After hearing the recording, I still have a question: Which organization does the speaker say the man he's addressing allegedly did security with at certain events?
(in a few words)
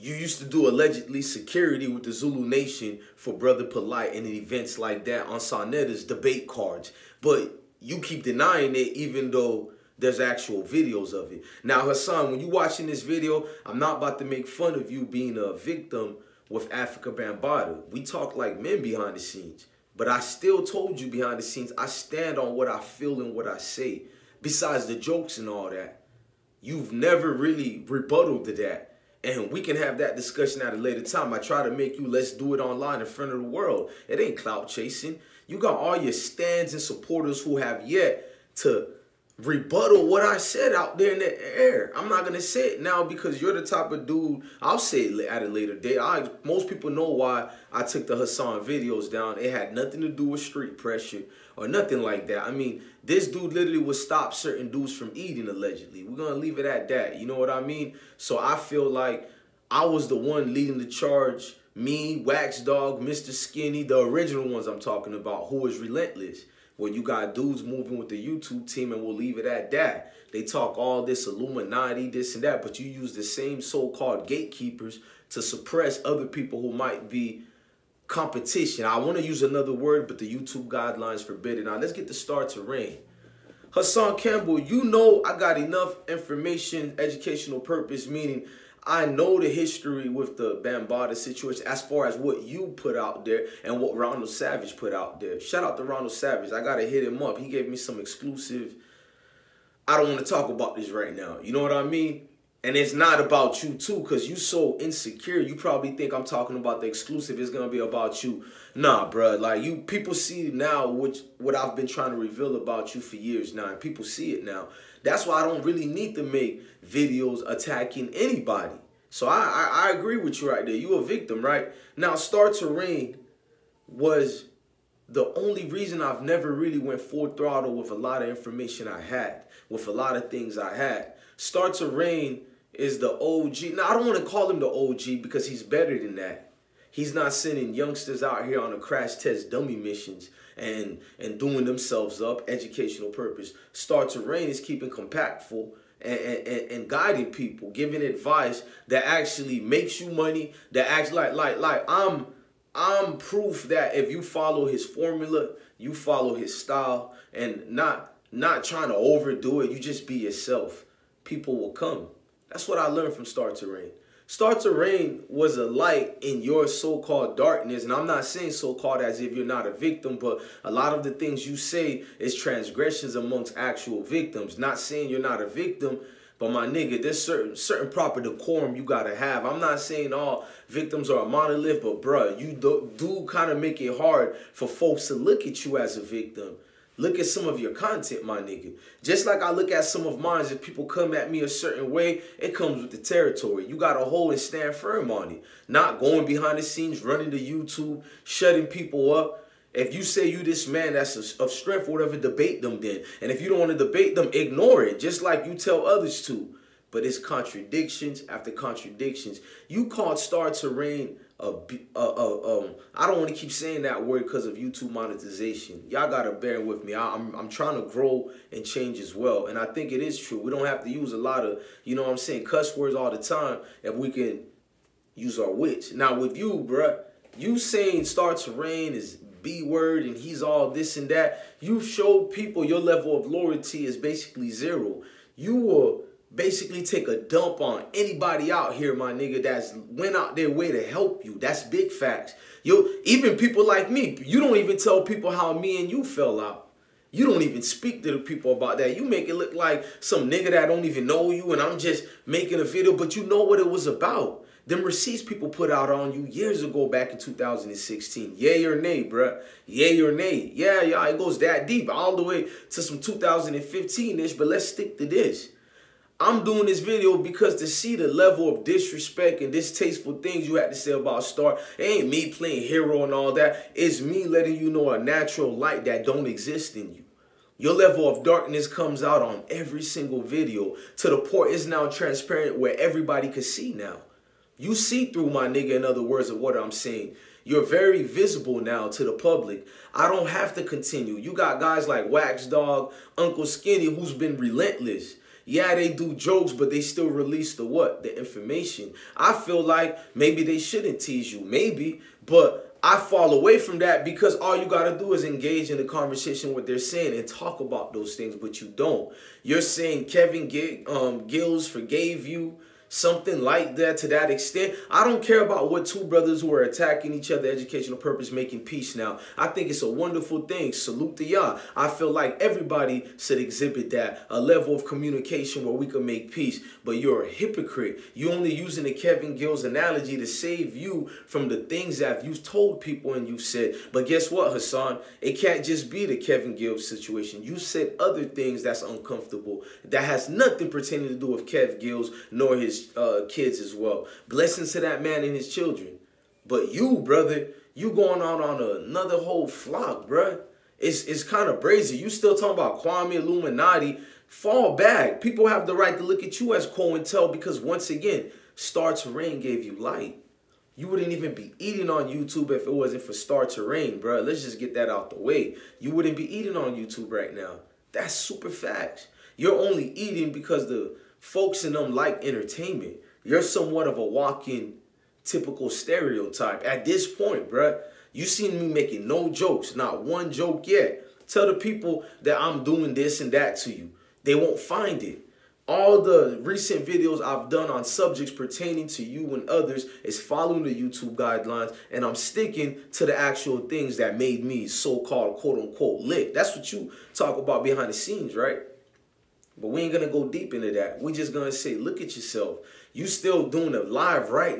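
Zulu Nation.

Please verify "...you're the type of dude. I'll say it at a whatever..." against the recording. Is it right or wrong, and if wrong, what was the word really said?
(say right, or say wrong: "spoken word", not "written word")
wrong: "later", not "whatever".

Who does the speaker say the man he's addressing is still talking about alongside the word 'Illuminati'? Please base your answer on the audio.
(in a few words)
Kwame.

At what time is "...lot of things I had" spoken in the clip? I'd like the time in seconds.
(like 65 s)
129 s.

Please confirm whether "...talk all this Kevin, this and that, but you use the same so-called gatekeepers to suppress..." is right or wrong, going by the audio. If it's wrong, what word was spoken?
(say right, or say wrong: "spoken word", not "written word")
wrong: "Illuminati", not "Kevin".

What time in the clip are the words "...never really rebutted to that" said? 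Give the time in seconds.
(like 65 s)
26 s.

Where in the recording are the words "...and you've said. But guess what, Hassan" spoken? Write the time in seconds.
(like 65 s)
333 s.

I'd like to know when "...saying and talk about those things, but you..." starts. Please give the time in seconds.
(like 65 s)
306 s.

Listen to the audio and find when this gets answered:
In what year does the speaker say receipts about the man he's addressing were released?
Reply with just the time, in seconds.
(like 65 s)
257 s.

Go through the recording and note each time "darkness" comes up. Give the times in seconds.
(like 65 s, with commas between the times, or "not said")
167 s, 278 s.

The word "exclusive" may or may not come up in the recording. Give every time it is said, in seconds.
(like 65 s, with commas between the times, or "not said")
97 s, 106 s.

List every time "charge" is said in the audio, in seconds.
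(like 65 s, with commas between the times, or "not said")
60 s.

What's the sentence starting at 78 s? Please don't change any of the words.
I want to use another word, but the YouTube guidelines forbid it.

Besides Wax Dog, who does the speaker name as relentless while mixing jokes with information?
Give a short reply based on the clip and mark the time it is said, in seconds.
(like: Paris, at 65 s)
Uncle Skinny, at 293 s.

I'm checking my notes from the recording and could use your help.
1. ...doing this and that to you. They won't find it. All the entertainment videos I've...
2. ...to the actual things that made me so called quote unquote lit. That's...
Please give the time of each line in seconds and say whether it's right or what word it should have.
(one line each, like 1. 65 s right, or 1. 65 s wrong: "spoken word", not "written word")
1. 382 s wrong: "recent", not "entertainment"
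2. 392 s right.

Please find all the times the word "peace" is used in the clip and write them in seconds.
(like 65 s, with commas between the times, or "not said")
318 s, 326 s.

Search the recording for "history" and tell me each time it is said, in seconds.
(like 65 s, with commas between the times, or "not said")
89 s.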